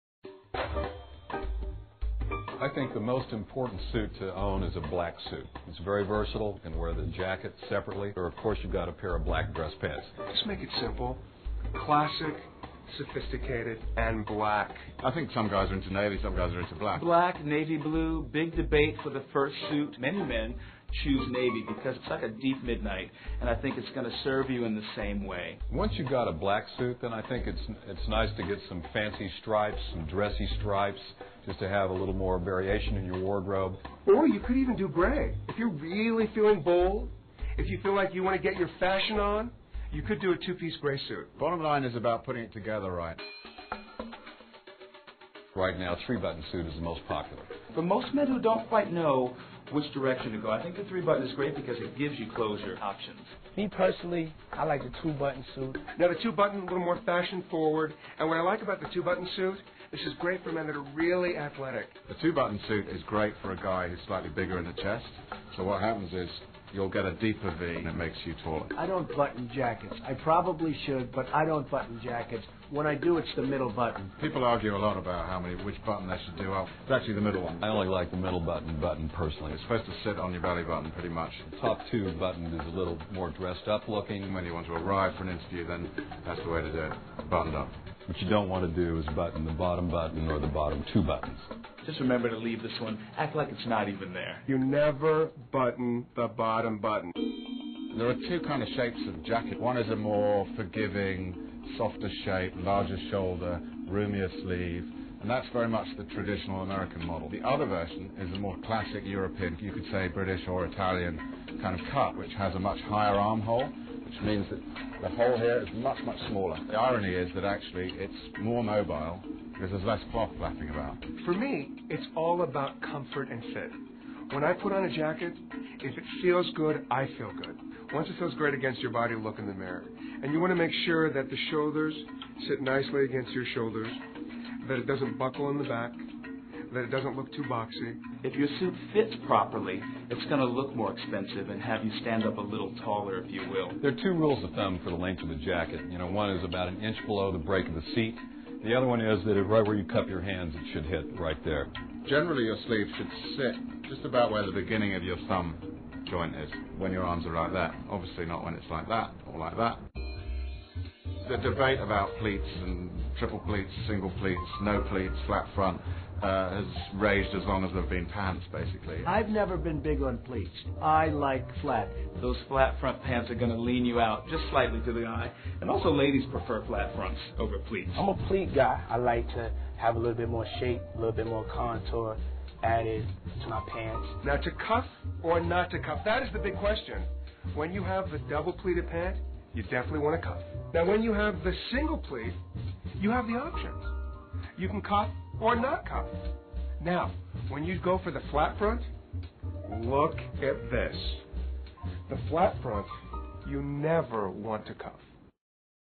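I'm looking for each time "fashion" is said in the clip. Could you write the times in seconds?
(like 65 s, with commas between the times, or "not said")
38 s, 57 s.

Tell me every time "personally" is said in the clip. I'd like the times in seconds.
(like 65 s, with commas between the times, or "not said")
53 s, 79 s.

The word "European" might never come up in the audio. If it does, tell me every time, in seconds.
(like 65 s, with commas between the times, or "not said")
109 s.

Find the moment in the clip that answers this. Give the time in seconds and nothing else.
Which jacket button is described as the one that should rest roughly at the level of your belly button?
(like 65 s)
77 s.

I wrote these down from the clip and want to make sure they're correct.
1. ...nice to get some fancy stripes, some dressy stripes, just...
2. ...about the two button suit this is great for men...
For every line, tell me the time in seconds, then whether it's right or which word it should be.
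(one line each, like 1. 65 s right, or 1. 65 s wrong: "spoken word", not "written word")
1. 28 s right
2. 58 s right.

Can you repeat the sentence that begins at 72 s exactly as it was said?
When I do, it's the middle button.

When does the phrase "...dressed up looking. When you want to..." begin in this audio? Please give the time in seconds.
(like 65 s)
83 s.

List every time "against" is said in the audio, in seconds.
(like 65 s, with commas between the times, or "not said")
128 s, 133 s.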